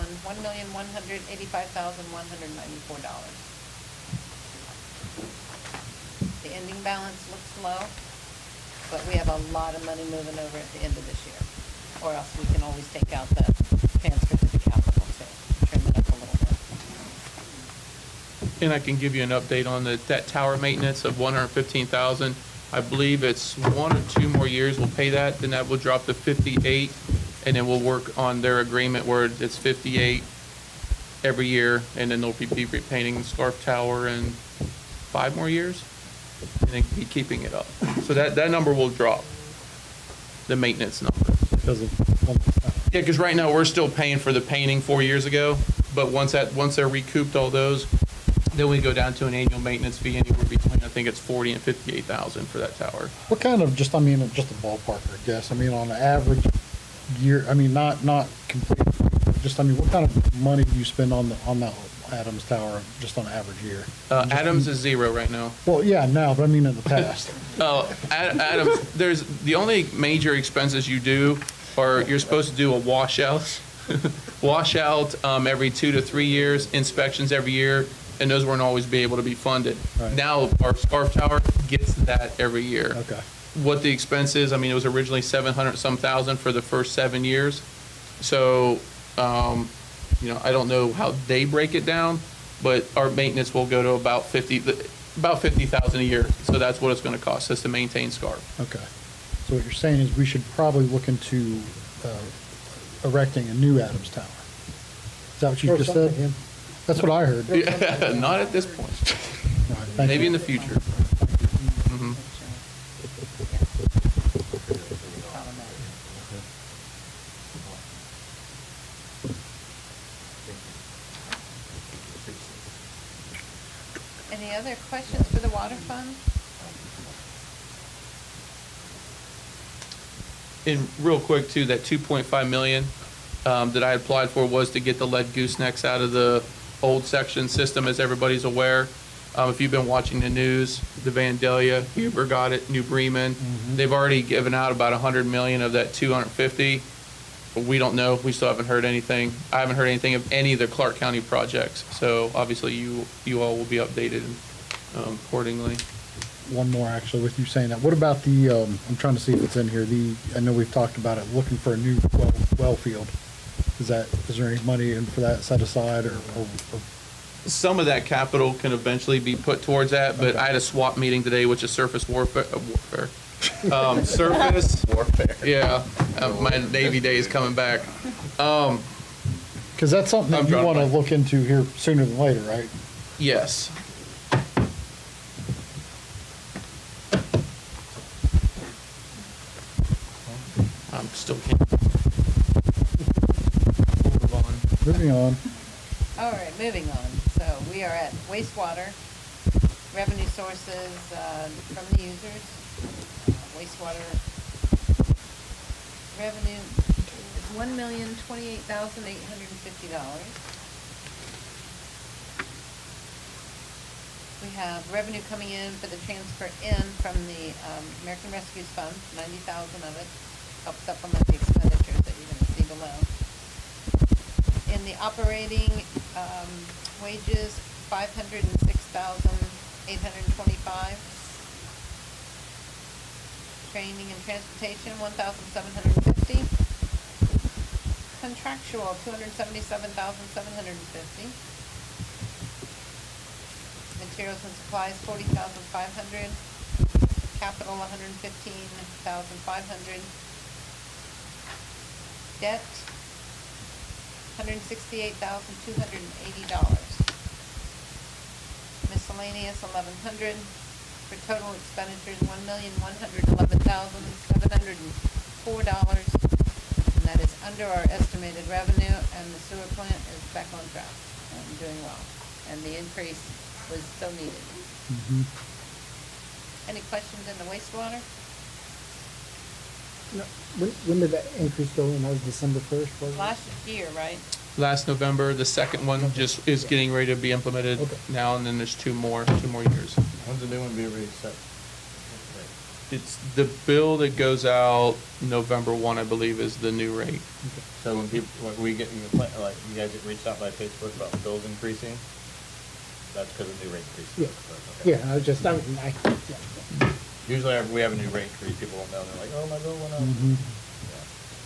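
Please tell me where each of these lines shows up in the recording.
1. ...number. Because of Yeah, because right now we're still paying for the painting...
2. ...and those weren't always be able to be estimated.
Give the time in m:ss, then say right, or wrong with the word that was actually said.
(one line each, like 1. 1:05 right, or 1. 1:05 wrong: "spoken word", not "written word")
1. 0:41 right
2. 1:18 wrong: "funded", not "estimated".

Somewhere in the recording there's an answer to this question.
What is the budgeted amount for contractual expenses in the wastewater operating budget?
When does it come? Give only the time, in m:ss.
3:59.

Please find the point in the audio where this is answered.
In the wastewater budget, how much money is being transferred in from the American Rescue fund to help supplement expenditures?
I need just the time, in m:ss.
3:39.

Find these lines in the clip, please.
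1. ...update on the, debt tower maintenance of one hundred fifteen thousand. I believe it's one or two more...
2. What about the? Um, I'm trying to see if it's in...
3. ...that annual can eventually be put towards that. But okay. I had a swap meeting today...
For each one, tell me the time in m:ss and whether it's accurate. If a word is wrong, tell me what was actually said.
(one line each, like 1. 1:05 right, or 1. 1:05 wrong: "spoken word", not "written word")
1. 0:19 right
2. 2:37 right
3. 2:47 wrong: "capital", not "annual".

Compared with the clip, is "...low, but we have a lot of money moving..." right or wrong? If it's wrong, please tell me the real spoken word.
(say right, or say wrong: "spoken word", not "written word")
right.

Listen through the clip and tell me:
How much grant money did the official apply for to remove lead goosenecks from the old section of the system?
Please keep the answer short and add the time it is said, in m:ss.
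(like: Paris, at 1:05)
$2.5 million, at 2:11.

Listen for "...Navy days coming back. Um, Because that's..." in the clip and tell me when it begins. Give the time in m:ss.
2:56.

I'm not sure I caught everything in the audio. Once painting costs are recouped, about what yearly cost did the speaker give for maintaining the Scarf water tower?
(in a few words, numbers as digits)
$50,000.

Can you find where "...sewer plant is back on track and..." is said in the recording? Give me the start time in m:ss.
4:29.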